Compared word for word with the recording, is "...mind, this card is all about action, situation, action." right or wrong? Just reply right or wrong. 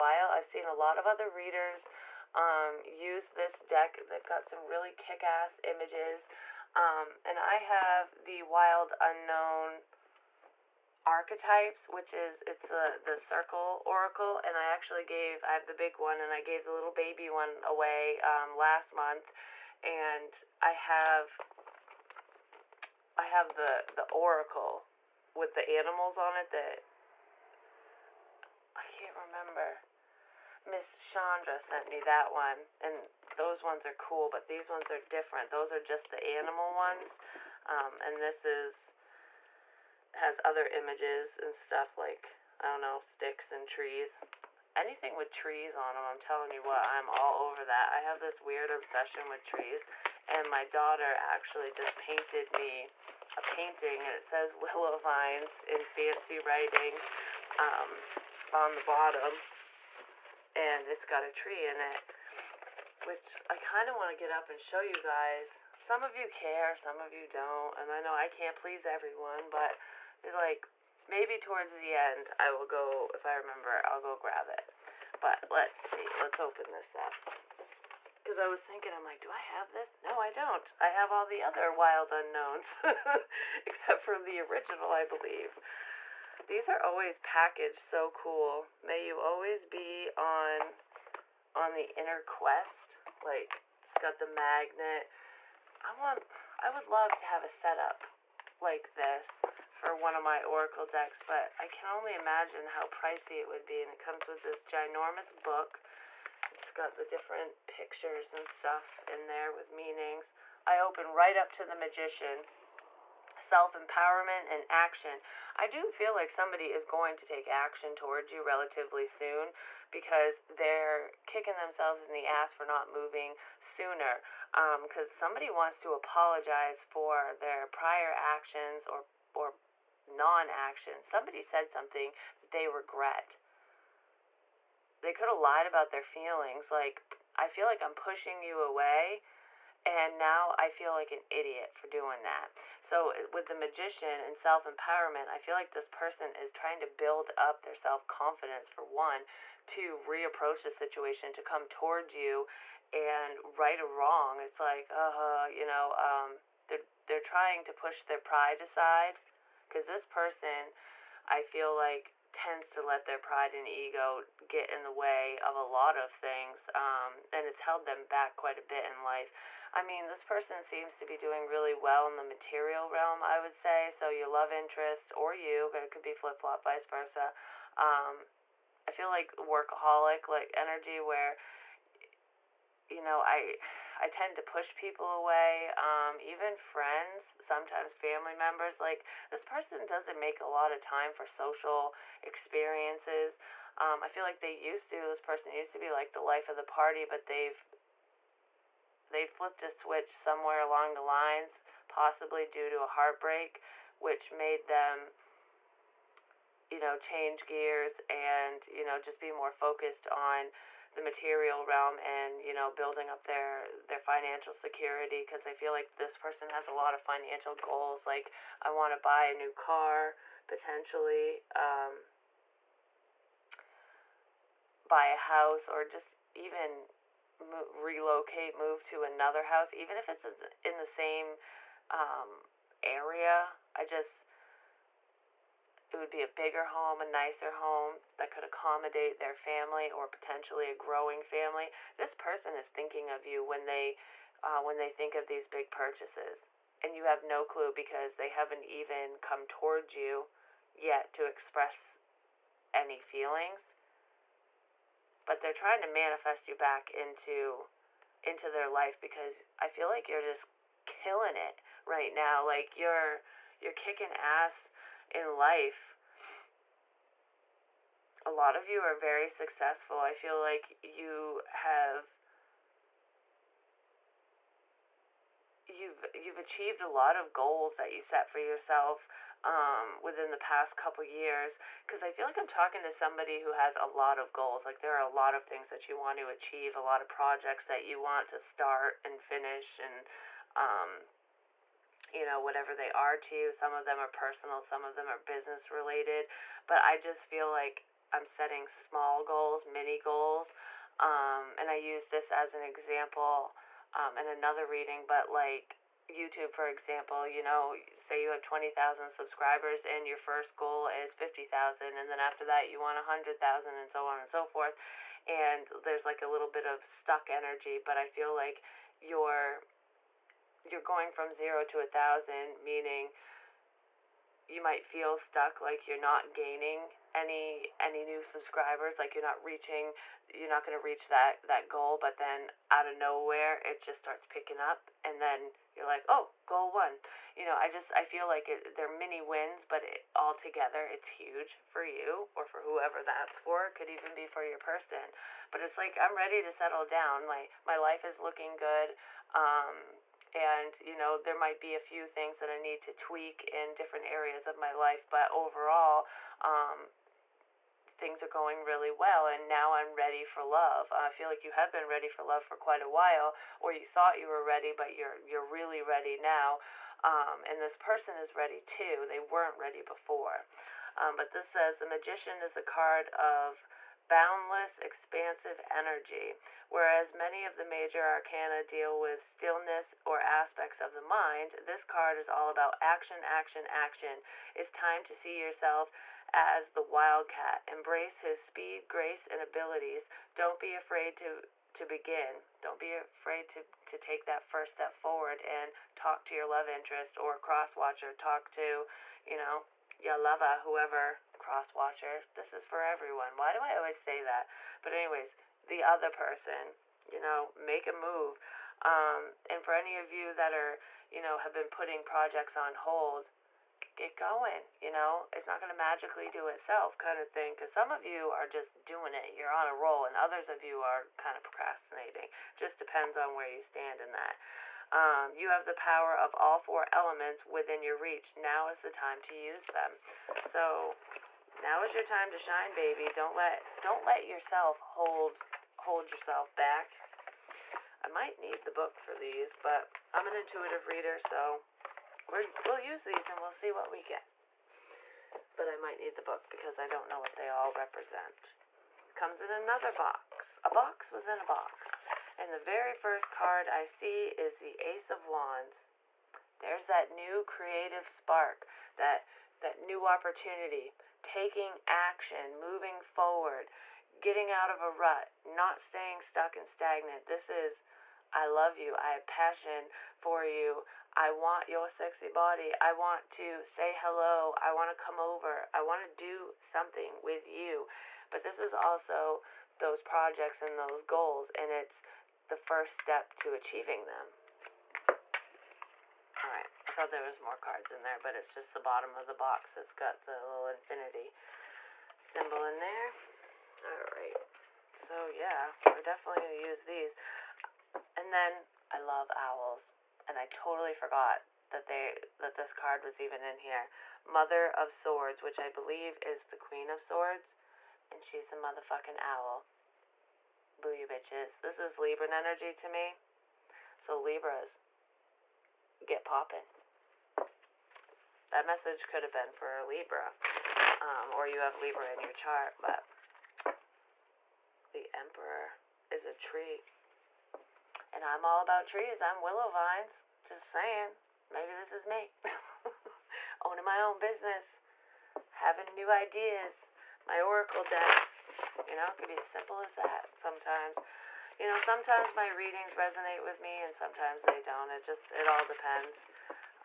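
wrong.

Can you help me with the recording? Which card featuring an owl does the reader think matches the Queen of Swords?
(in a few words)
Mother of Swords.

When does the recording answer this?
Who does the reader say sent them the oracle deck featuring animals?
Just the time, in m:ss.
0:30.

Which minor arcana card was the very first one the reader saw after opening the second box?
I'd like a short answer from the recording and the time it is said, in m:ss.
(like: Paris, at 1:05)
Ace of Wands, at 7:34.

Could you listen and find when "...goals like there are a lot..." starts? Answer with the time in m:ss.
4:44.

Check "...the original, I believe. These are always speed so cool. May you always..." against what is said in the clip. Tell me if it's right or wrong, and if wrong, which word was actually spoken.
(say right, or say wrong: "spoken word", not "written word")
wrong: "packaged", not "speed".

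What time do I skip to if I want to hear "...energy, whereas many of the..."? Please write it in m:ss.
6:15.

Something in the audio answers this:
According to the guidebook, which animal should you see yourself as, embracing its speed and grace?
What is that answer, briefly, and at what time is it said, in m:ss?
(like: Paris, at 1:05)
wildcat, at 6:26.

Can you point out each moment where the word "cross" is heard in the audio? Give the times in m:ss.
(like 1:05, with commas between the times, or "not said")
6:37, 6:41.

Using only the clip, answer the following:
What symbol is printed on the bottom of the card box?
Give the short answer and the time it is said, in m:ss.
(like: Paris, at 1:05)
infinity symbol, at 8:10.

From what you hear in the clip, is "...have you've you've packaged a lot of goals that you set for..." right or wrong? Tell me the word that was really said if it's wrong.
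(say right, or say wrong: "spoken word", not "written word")
wrong: "achieved", not "packaged".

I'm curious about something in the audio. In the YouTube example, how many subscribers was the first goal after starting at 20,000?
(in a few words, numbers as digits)
50,000.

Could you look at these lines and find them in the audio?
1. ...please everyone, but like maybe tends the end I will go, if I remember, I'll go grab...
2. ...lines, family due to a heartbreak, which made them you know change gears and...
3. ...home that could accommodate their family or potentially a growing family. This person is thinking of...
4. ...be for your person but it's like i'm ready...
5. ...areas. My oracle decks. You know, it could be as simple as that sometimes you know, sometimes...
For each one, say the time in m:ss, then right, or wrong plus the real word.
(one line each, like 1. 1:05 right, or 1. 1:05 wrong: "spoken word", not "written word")
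1. 1:08 wrong: "towards", not "tends"
2. 3:21 wrong: "possibly", not "family"
3. 3:57 right
4. 5:44 right
5. 8:56 wrong: "ideas", not "areas".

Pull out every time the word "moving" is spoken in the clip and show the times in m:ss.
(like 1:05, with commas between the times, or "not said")
2:02, 7:42.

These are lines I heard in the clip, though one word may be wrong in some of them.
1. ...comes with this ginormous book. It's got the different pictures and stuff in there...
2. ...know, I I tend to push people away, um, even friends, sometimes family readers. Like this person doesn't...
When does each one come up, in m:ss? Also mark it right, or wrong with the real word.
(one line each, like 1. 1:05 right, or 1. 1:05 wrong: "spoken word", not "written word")
1. 1:43 right
2. 3:03 wrong: "members", not "readers".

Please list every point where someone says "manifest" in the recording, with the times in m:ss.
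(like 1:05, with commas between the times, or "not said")
4:15.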